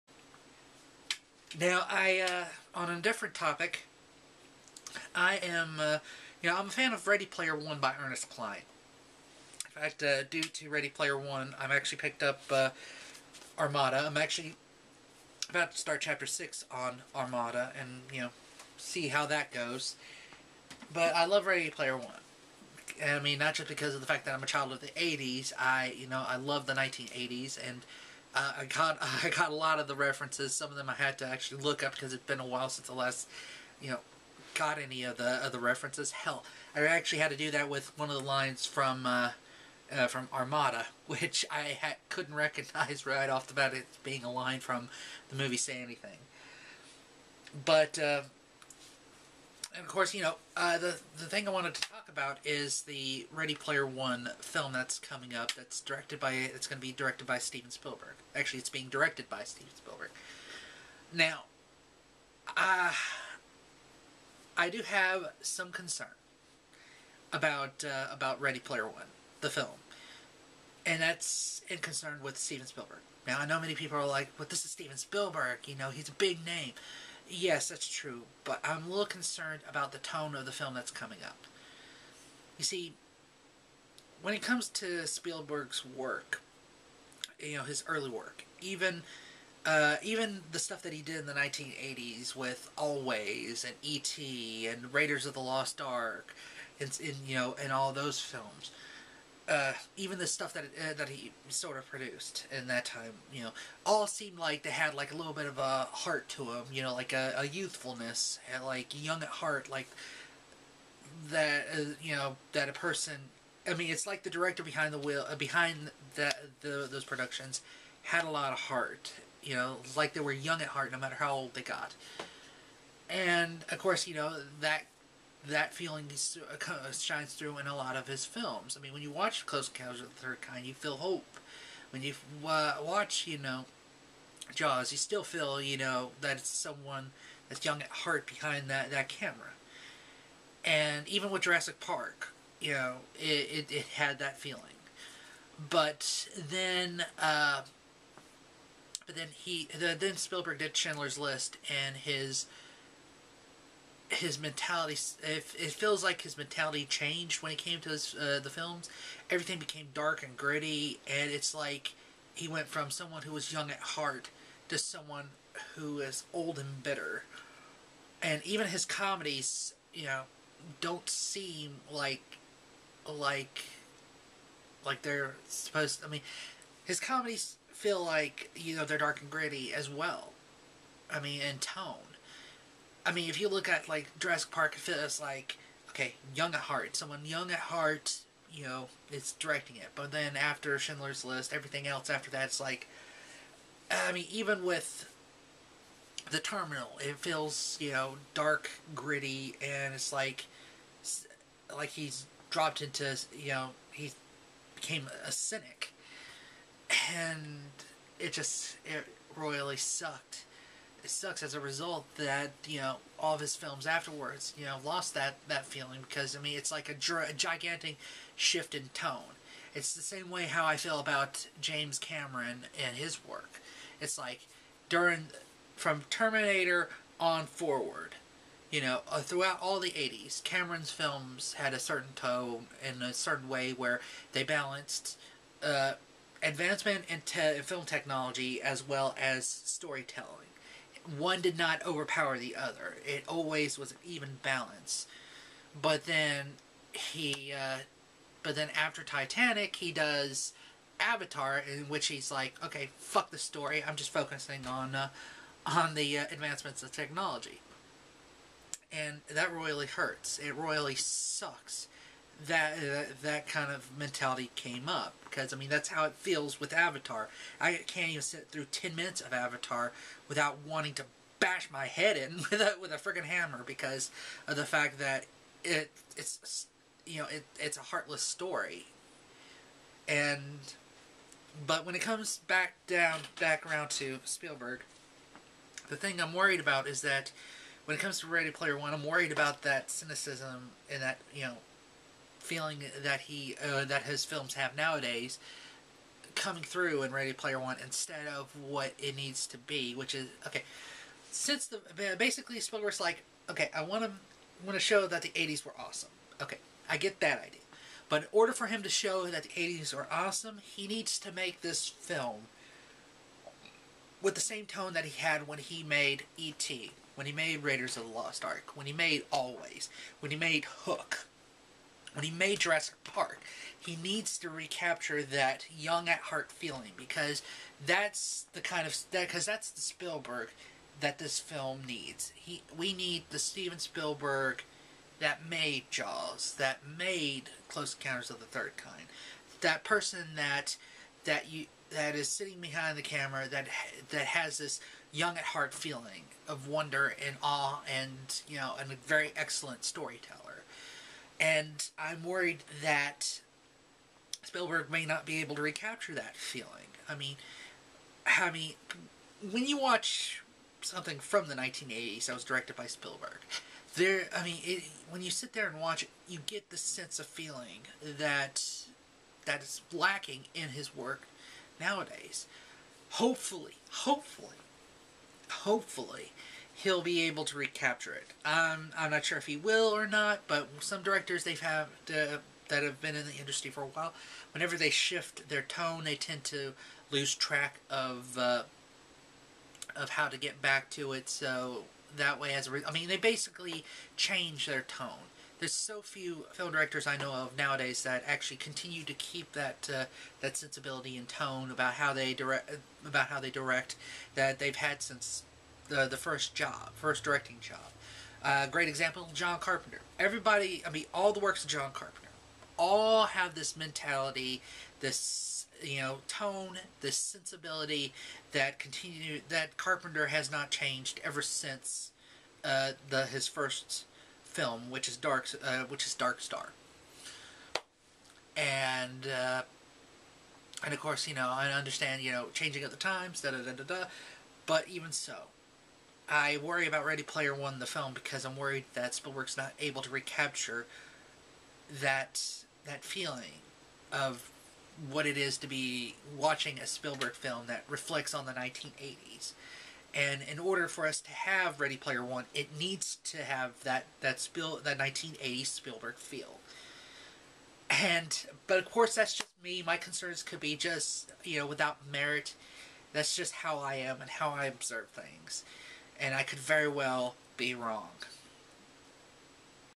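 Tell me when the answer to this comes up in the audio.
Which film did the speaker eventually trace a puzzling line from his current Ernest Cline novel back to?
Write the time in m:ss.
0:45.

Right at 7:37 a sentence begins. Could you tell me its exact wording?
And but of course, that's just me.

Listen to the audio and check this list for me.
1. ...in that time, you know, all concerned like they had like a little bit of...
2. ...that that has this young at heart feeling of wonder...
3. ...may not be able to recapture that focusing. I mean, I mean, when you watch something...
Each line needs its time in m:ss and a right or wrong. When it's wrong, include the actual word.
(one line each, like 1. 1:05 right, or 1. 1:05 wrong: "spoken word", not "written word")
1. 1:42 wrong: "seemed", not "concerned"
2. 5:43 right
3. 5:54 wrong: "feeling", not "focusing".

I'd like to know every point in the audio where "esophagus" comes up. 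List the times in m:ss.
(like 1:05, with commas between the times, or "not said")
not said.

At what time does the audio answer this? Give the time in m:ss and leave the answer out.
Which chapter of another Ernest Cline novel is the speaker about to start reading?
0:15.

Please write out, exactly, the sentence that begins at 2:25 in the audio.
But then, uh, but then he, the, then Spielberg did Schindler's List, and his his mentality.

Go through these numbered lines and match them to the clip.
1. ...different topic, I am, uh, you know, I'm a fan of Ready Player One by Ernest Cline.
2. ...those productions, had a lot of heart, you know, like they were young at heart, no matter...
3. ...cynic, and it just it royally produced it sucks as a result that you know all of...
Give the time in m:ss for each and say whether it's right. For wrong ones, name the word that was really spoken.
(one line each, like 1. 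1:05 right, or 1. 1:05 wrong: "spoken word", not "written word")
1. 0:03 right
2. 1:56 right
3. 3:25 wrong: "sucked", not "produced".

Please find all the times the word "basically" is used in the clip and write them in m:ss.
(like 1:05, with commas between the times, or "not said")
5:02, 6:33.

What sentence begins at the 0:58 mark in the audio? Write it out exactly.
Actually, it's being directed by Steven Spielberg.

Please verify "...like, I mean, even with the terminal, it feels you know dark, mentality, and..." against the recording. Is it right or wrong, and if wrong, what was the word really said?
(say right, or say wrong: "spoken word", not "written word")
wrong: "gritty", not "mentality".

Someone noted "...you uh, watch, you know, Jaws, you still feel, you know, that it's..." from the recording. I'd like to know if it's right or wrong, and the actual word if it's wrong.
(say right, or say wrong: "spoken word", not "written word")
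right.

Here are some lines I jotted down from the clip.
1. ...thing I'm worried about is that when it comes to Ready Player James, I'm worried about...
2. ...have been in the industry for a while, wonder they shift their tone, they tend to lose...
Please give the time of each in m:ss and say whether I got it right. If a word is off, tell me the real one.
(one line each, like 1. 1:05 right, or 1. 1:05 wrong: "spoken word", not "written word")
1. 4:45 wrong: "One", not "James"
2. 6:22 wrong: "whenever", not "wonder".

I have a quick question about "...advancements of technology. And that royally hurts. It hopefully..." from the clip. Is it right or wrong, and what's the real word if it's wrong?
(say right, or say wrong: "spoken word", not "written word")
wrong: "royally", not "hopefully".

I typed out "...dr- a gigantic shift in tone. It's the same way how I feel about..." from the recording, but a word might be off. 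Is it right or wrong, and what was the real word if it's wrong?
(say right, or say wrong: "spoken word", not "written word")
right.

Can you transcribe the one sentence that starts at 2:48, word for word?
And even his comedies, you know, don't seem like like like they're supposed.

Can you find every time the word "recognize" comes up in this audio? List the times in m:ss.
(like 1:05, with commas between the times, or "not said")
0:42.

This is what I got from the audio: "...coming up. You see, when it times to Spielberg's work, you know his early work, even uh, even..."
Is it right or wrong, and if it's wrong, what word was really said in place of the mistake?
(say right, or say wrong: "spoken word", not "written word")
wrong: "comes", not "times".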